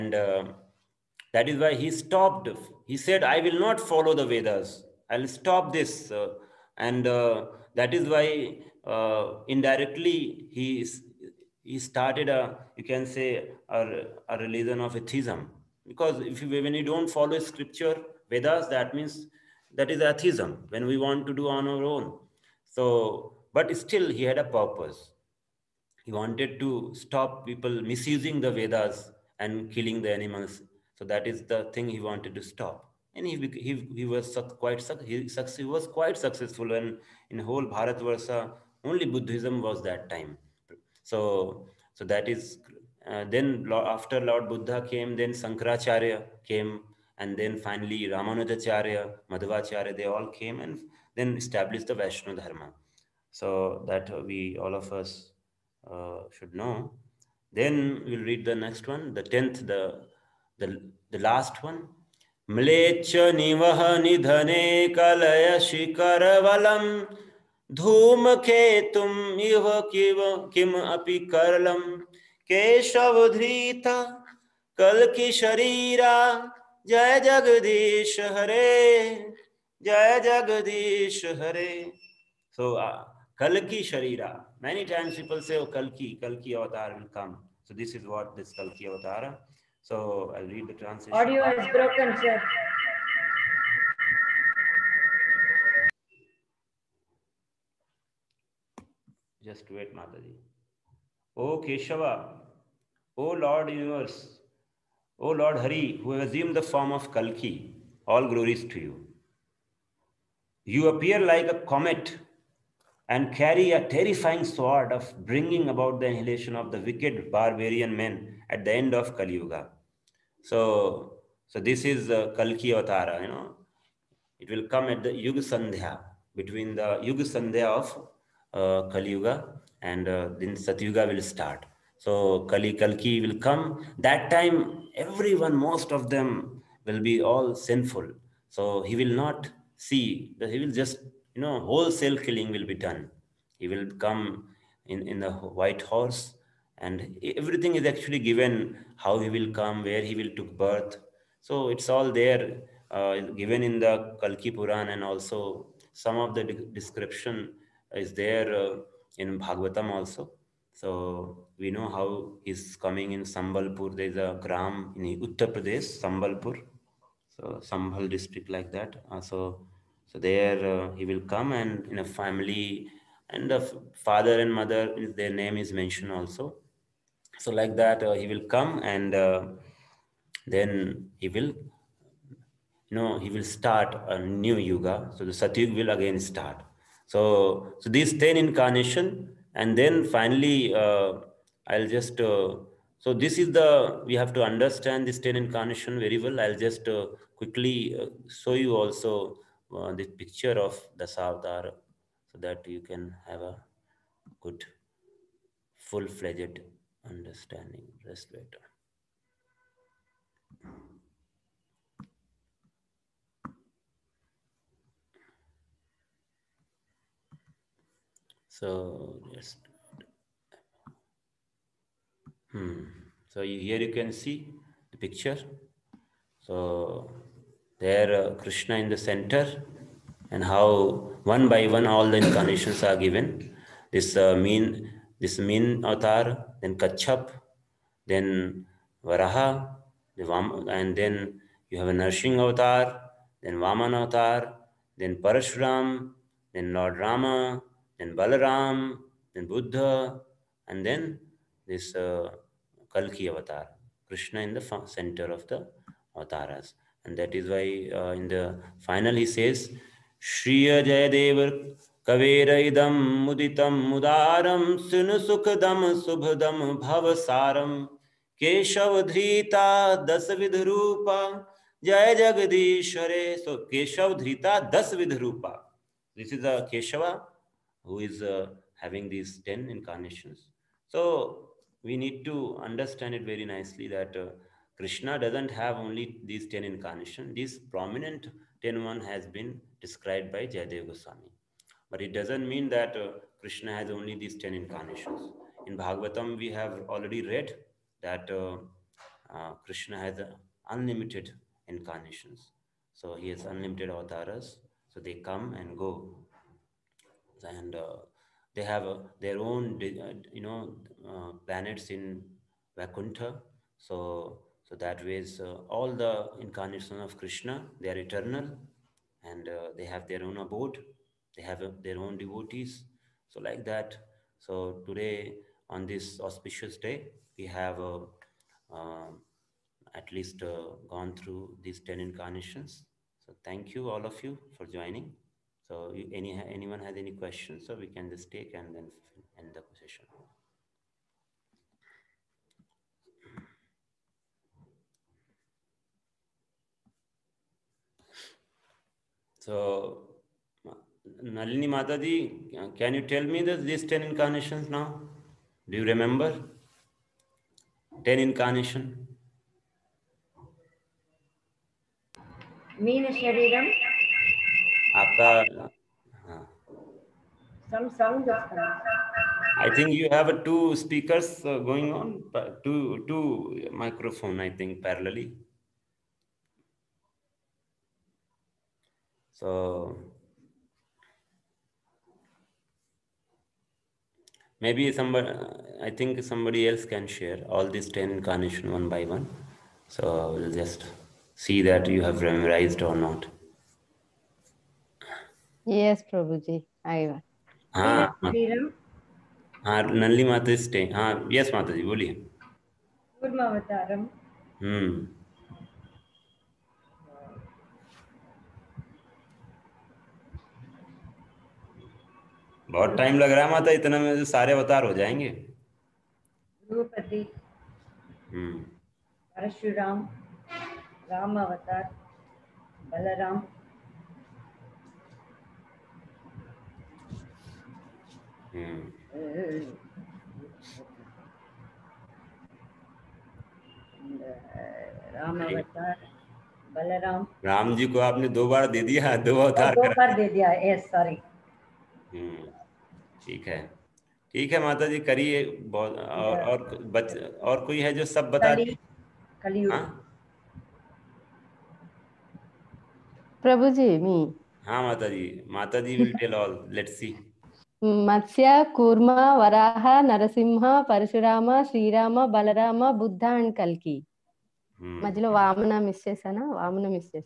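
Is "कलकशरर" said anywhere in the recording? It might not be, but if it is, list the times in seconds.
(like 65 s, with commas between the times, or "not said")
74 s, 83 s.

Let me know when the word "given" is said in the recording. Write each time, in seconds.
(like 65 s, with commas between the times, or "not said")
148 s, 153 s, 232 s.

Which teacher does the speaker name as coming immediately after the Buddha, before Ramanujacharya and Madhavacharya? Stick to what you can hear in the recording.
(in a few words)
Sankaracharya.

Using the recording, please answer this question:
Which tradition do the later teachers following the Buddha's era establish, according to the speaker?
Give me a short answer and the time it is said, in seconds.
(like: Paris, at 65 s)
Vaishnava Dharma, at 51 s.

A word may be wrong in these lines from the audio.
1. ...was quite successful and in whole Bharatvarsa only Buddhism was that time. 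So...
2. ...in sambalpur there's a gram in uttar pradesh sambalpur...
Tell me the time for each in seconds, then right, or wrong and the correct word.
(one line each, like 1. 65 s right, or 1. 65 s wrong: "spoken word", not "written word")
1. 35 s right
2. 163 s right.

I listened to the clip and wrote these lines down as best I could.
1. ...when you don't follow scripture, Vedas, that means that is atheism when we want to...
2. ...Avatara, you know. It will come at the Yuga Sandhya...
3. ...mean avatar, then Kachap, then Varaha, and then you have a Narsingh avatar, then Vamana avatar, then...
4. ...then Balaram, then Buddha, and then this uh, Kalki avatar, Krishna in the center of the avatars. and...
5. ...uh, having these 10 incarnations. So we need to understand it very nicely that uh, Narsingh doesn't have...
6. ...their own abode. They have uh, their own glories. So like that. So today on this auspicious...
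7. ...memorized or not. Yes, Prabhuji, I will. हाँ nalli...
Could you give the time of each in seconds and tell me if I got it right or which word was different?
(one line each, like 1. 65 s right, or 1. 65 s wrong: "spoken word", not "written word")
1. 16 s right
2. 122 s right
3. 235 s right
4. 247 s right
5. 278 s wrong: "Krishna", not "Narsingh"
6. 320 s wrong: "devotees", not "glories"
7. 392 s right.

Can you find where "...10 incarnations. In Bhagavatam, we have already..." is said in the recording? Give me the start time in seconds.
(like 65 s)
294 s.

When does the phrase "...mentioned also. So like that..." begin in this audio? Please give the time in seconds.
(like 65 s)
175 s.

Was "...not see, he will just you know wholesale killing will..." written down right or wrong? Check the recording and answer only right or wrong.
right.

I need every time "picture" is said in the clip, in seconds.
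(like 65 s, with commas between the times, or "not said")
200 s, 224 s.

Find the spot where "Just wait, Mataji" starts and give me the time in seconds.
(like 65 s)
99 s.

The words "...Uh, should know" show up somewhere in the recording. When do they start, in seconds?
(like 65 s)
55 s.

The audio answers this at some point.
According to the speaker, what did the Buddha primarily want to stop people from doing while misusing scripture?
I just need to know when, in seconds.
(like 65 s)
29 s.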